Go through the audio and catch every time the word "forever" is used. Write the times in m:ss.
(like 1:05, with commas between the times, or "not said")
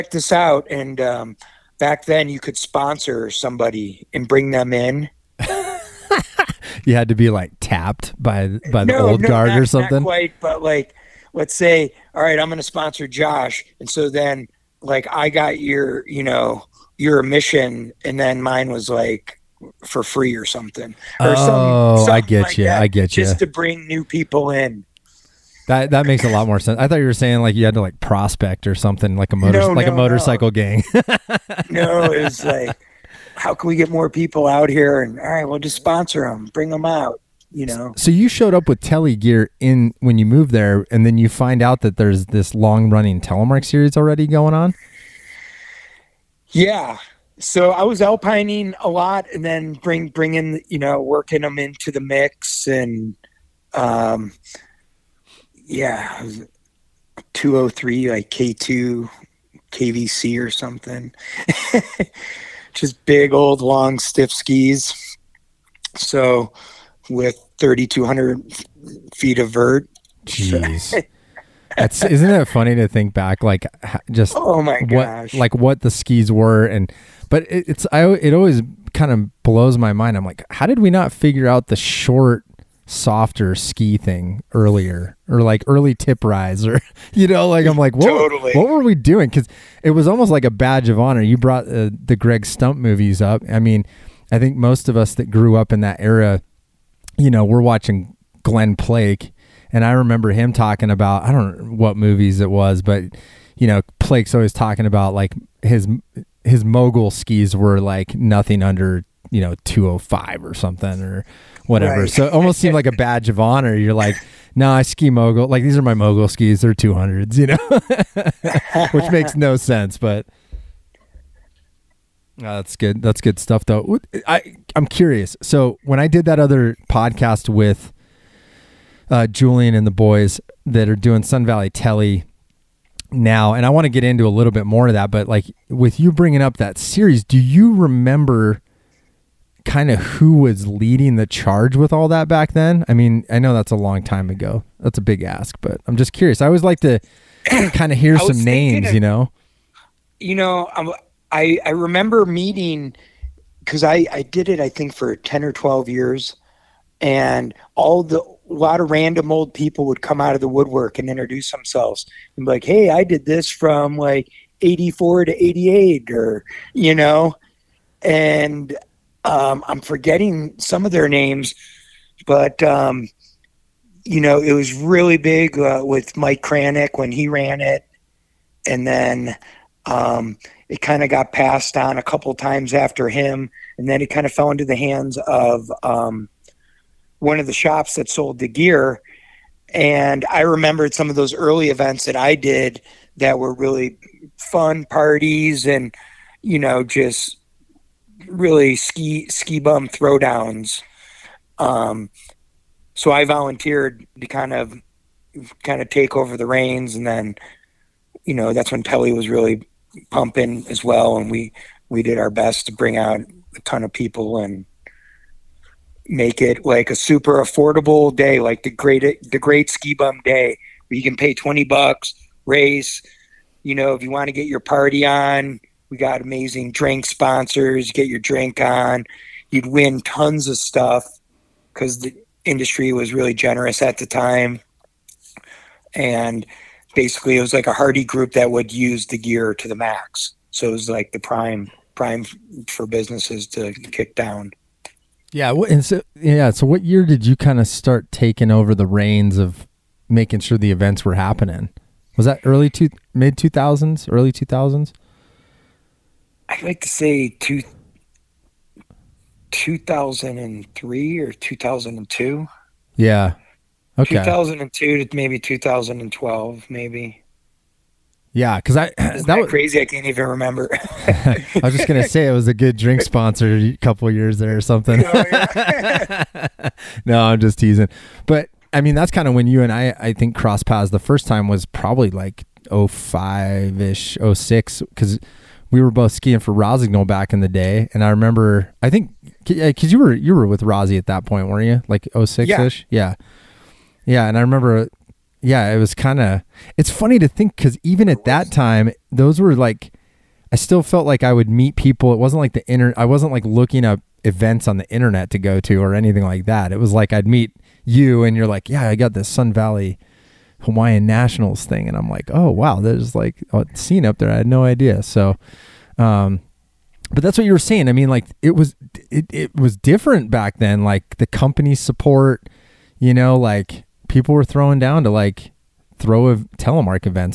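not said.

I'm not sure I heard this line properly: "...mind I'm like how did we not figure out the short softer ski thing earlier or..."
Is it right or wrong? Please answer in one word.
right.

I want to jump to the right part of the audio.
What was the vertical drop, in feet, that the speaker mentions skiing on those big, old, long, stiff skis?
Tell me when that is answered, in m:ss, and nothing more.
1:07.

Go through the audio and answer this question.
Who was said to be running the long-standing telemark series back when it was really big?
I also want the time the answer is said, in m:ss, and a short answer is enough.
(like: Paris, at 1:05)
Mike Kranick, at 2:56.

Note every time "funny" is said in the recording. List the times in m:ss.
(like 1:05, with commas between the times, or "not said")
1:12, 4:56.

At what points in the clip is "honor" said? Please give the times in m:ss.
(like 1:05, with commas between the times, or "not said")
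1:31, 1:53.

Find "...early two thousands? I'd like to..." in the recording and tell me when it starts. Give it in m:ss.
4:14.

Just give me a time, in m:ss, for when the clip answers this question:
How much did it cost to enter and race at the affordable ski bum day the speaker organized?
3:41.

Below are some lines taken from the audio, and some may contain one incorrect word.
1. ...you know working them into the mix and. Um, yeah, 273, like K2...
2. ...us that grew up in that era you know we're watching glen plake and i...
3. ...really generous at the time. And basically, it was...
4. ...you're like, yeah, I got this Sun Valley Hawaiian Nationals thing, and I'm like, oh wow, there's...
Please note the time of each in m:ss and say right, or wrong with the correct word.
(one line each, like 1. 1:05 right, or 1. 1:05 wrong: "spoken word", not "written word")
1. 0:50 wrong: "203", not "273"
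2. 1:34 right
3. 3:53 right
4. 5:08 right.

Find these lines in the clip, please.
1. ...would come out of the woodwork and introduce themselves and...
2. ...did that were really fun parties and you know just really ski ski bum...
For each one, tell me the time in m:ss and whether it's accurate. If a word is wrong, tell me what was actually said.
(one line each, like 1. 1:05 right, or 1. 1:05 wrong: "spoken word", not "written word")
1. 2:39 right
2. 3:12 right.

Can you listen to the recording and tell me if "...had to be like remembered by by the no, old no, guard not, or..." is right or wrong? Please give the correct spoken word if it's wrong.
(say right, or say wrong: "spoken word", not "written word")
wrong: "tapped", not "remembered".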